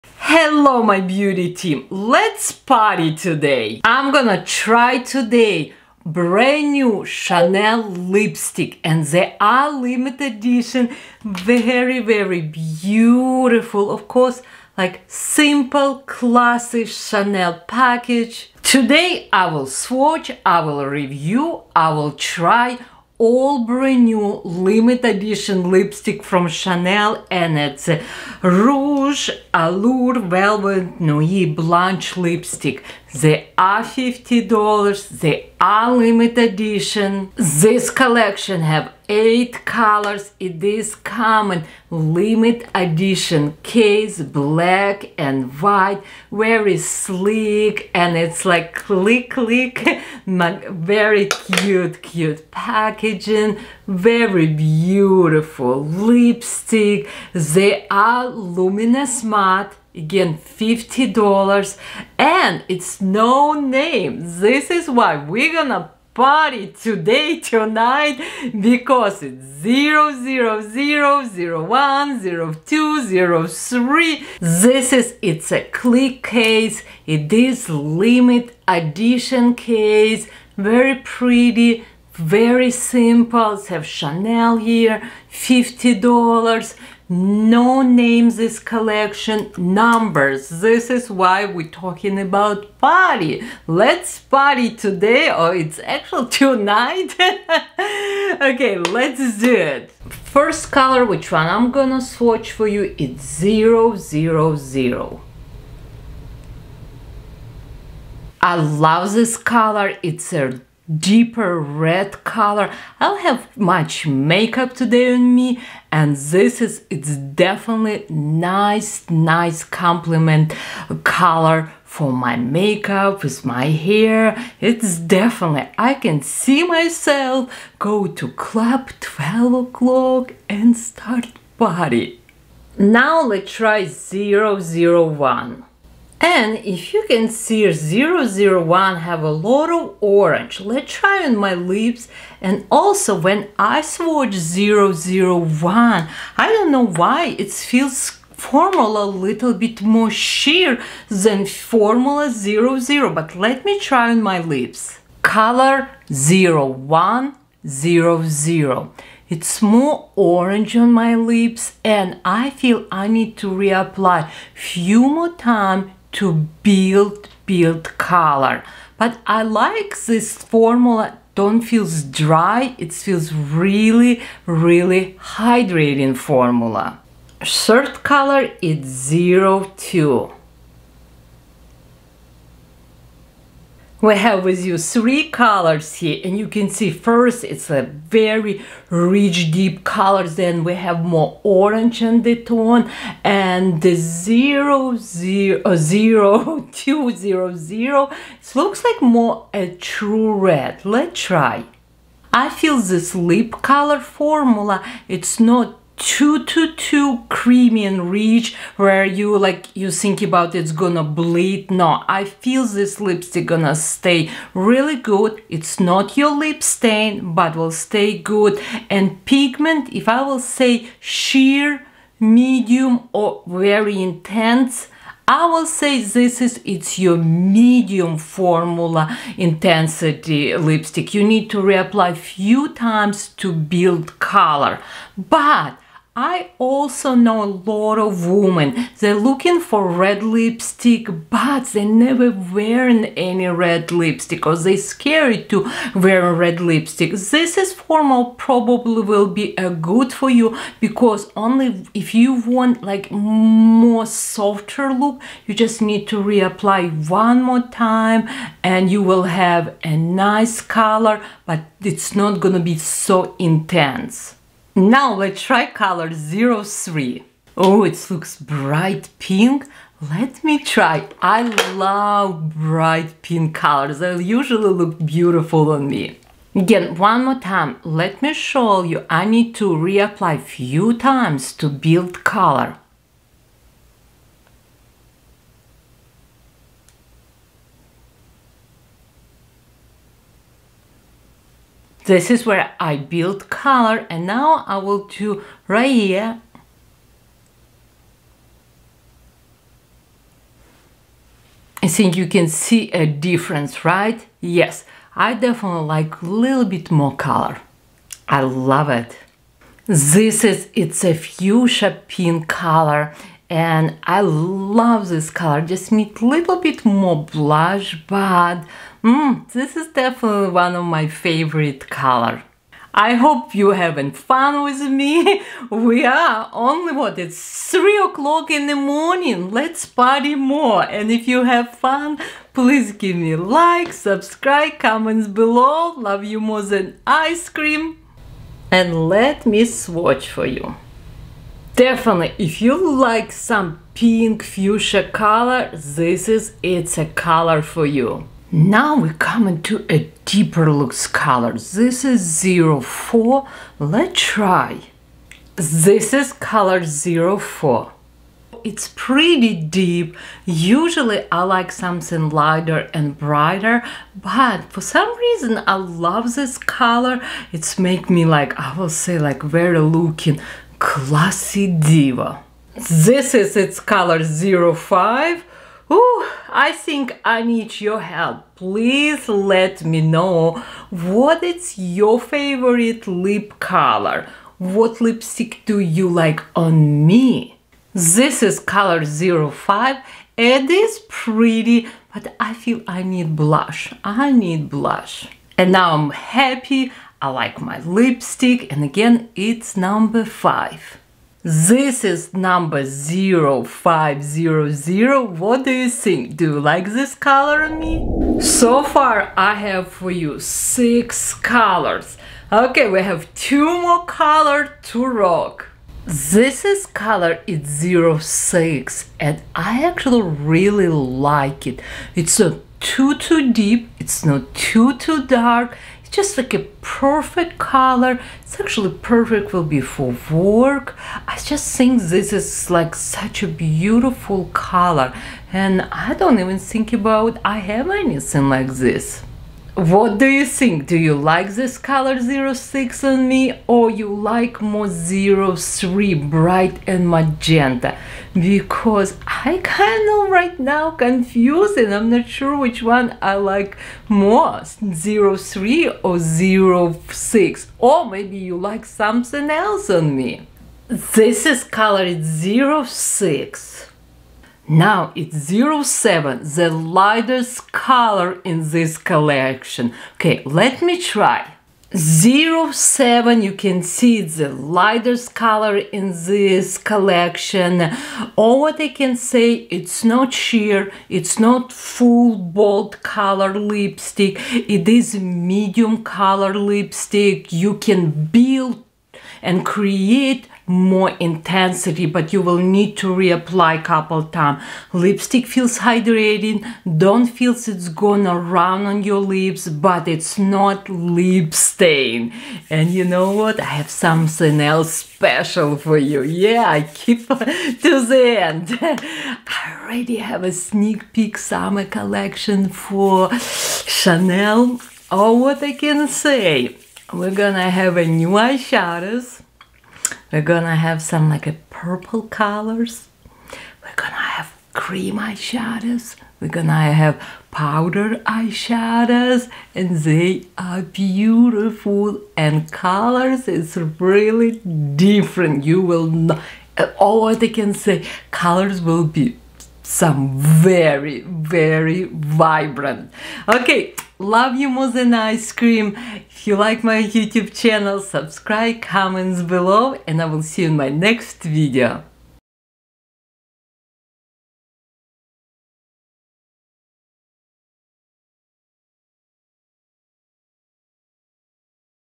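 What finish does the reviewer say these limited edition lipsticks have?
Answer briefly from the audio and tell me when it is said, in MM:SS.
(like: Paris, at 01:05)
luminous matte, at 00:58.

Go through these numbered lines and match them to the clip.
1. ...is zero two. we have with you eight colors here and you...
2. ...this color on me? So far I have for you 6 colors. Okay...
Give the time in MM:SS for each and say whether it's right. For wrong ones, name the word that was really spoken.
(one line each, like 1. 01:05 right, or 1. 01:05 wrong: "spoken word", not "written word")
1. 02:58 wrong: "three", not "eight"
2. 06:46 right.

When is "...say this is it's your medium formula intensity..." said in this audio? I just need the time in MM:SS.
03:45.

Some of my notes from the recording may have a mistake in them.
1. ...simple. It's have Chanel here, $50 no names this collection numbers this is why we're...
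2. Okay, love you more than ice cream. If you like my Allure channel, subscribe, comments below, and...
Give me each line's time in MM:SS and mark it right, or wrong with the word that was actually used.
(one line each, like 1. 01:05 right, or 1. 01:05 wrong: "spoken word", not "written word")
1. 01:22 right
2. 09:03 wrong: "YouTube", not "Allure".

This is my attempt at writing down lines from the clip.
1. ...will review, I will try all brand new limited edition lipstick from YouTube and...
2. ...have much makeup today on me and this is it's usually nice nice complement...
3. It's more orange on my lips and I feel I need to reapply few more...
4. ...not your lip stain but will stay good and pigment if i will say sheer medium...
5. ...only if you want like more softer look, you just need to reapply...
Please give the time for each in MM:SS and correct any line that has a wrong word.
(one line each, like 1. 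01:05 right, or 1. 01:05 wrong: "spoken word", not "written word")
1. 00:20 wrong: "Chanel", not "YouTube"
2. 01:53 wrong: "definitely", not "usually"
3. 02:39 right
4. 03:35 right
5. 04:11 right.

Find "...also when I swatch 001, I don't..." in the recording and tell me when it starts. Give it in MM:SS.
02:22.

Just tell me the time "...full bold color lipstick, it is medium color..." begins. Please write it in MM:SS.
08:01.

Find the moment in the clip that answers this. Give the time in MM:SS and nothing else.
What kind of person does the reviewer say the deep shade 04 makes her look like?
06:10.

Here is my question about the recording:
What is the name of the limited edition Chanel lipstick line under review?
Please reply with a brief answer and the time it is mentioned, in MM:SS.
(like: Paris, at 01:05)
Nuit Blanche, at 00:30.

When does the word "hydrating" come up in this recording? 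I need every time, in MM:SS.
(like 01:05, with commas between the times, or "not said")
02:55, 08:15.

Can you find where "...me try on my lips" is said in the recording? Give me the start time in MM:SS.
02:33.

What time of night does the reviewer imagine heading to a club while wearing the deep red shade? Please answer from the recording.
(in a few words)
12 o'clock.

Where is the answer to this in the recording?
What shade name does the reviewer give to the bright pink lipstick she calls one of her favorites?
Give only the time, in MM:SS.
05:11.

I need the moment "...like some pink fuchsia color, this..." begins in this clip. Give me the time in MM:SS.
05:42.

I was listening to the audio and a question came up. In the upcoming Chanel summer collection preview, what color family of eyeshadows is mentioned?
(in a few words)
purple.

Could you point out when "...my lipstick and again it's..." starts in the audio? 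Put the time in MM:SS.
06:37.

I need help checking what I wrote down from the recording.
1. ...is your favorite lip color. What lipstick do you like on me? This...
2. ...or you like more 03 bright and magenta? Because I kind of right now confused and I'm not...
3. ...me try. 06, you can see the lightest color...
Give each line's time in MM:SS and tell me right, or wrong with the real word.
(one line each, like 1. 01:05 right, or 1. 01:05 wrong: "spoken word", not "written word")
1. 06:21 right
2. 07:23 right
3. 07:50 wrong: "07", not "06".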